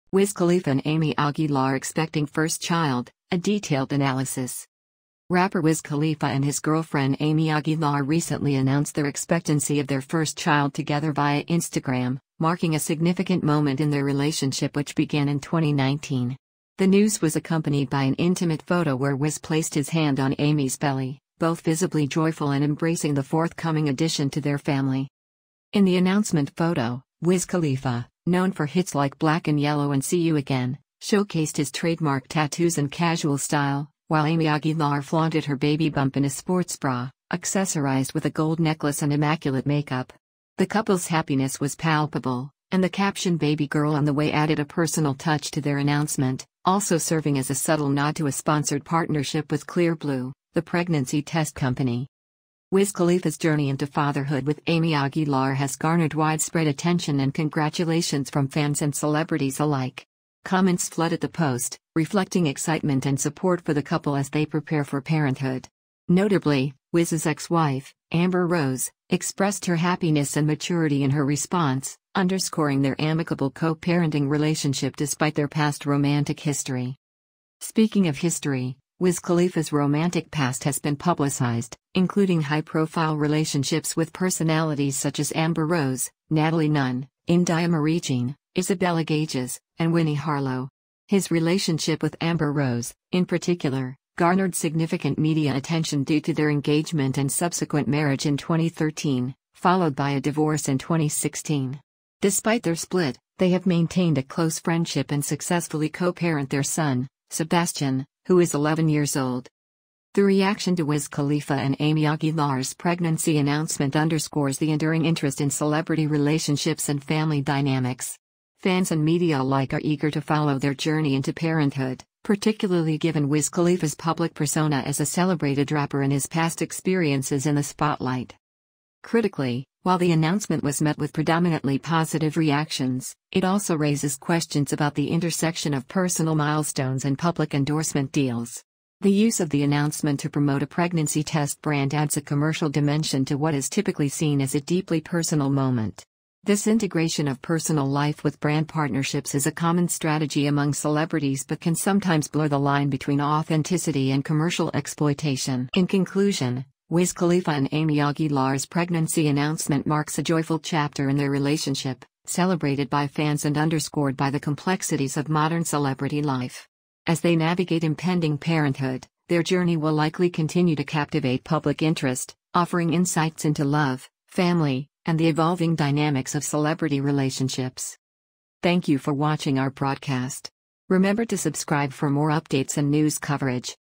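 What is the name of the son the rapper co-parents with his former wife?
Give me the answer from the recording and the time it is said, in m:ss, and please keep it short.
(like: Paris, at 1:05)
Sebastian, at 1:47.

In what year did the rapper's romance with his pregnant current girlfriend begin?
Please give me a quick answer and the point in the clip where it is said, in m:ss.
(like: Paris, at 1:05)
2019, at 0:15.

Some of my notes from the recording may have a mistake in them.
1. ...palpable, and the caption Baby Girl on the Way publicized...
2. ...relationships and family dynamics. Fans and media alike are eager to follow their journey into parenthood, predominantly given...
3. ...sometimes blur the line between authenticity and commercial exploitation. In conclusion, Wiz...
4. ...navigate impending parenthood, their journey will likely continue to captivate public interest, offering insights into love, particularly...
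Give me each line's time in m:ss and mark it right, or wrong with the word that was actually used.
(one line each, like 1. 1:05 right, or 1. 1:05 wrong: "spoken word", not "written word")
1. 0:41 wrong: "added", not "publicized"
2. 1:56 wrong: "particularly", not "predominantly"
3. 2:31 right
4. 2:47 wrong: "family", not "particularly".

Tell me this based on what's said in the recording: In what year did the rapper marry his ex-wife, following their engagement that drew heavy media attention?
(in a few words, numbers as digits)
2013.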